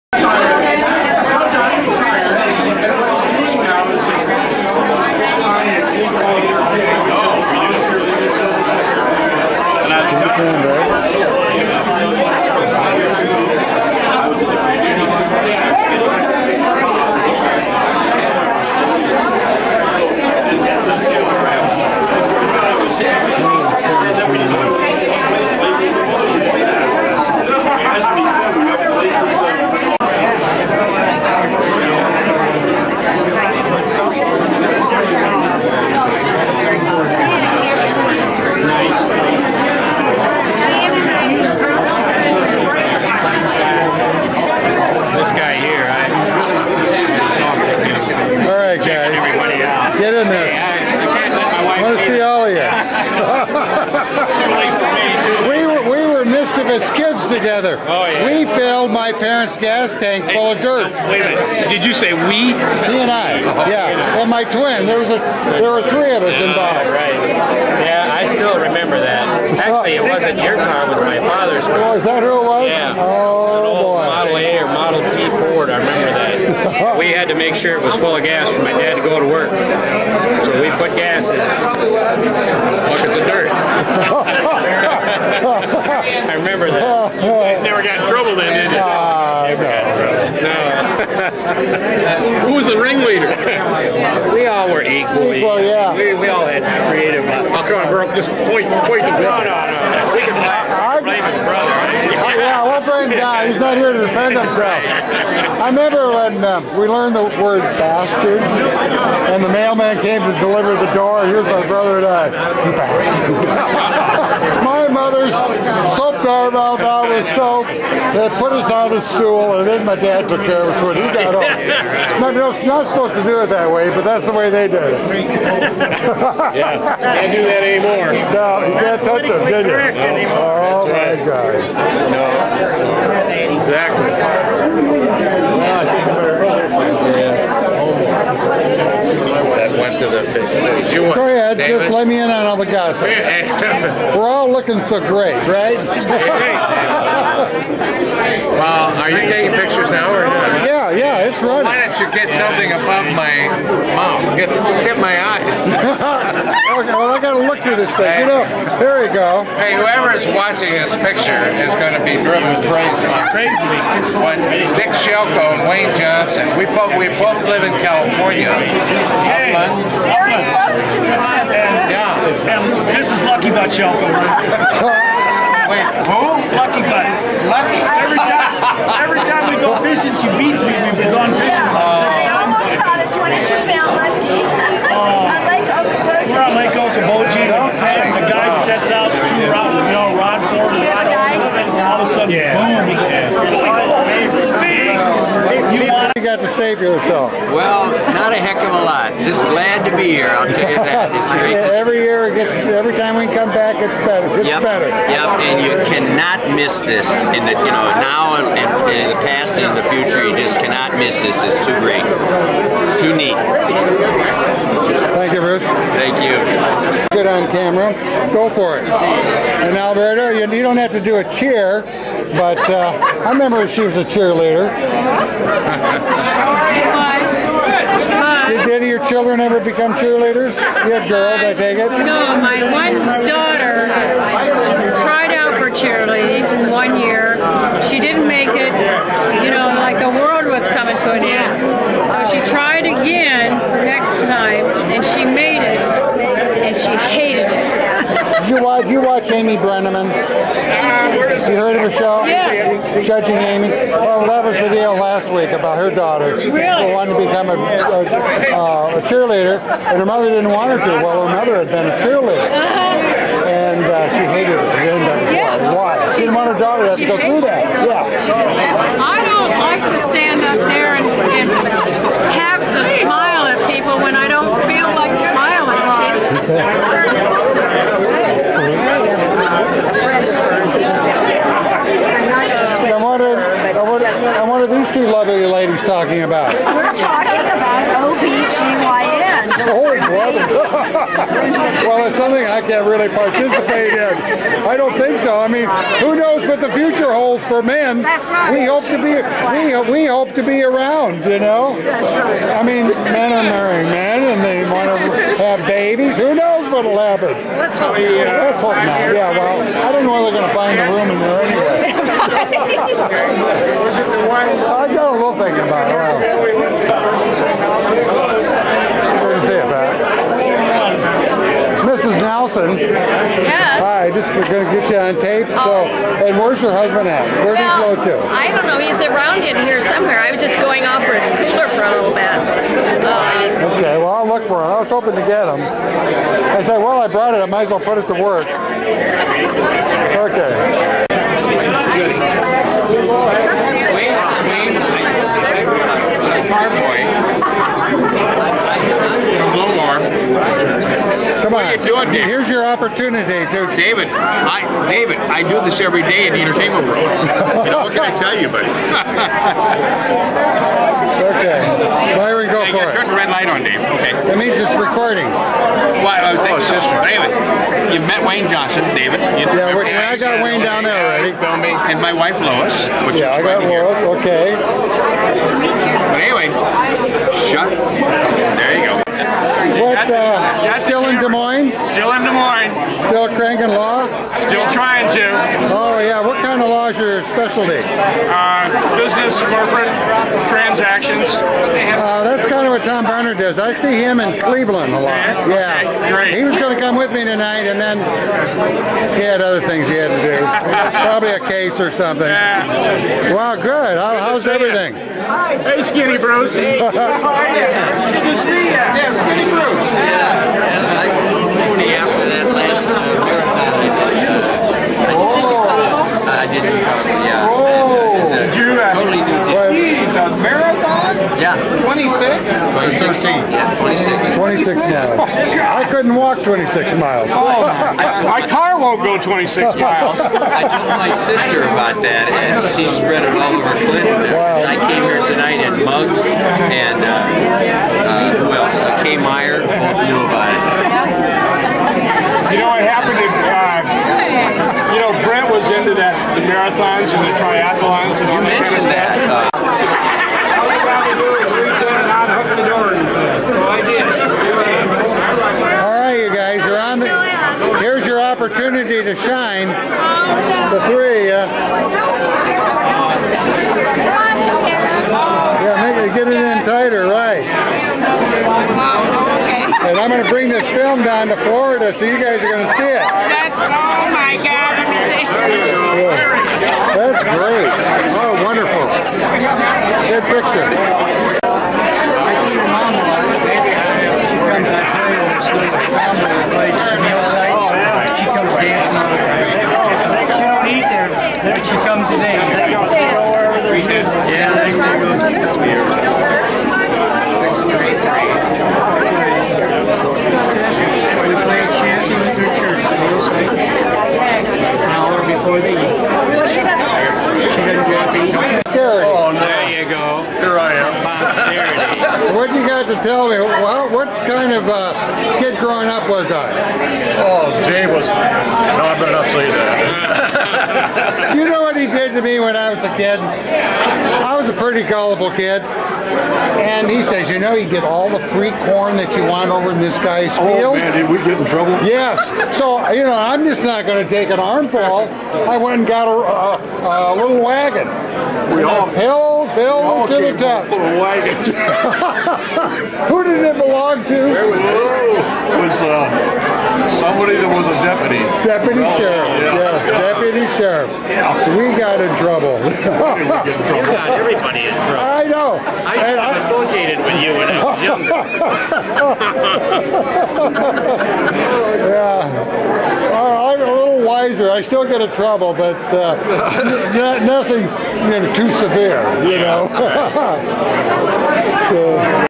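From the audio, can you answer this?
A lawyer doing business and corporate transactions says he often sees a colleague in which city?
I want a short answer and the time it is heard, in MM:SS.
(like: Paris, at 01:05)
Cleveland, at 06:34.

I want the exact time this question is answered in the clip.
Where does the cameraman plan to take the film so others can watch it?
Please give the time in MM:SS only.
07:51.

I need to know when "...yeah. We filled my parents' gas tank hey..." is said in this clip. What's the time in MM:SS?
00:58.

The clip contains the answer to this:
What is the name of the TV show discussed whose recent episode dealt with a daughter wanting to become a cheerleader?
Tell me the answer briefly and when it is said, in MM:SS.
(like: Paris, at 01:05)
Judging Amy, at 04:13.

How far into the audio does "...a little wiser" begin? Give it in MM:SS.
09:23.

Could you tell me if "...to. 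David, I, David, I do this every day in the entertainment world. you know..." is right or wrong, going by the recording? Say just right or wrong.
right.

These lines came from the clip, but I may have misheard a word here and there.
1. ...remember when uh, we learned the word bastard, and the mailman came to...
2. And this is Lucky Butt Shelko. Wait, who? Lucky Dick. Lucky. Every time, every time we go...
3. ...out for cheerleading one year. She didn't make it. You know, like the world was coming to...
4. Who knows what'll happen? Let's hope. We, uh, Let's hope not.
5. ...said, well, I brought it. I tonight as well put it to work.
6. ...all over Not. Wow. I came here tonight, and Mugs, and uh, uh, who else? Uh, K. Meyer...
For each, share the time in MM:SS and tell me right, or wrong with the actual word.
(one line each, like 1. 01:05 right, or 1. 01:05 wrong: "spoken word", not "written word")
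1. 01:45 right
2. 02:52 wrong: "Butt", not "Dick"
3. 03:55 right
4. 05:06 right
5. 05:36 wrong: "might", not "tonight"
6. 07:13 wrong: "Clinton", not "Not".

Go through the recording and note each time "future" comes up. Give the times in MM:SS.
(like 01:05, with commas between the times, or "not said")
03:29, 04:56.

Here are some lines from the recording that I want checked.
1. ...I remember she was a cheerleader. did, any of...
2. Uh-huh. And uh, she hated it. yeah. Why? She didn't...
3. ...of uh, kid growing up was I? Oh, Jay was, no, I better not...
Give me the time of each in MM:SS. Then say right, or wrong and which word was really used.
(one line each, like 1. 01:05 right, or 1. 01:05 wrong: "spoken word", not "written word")
1. 03:43 right
2. 04:22 right
3. 08:34 right.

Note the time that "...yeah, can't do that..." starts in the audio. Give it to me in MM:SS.
02:05.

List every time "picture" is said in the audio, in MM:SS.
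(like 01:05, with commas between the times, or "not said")
02:29, 02:40, 08:00.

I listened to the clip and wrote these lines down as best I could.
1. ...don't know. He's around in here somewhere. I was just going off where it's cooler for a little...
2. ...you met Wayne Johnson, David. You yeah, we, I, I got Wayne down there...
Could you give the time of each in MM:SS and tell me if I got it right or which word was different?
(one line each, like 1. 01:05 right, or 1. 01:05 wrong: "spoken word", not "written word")
1. 05:28 right
2. 06:07 right.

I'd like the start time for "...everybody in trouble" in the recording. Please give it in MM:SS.
09:14.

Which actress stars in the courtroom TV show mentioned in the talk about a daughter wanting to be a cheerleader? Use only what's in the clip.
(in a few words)
Amy Brenneman.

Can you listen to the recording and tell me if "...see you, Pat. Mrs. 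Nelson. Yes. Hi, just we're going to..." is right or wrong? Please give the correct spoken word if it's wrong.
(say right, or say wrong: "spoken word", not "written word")
right.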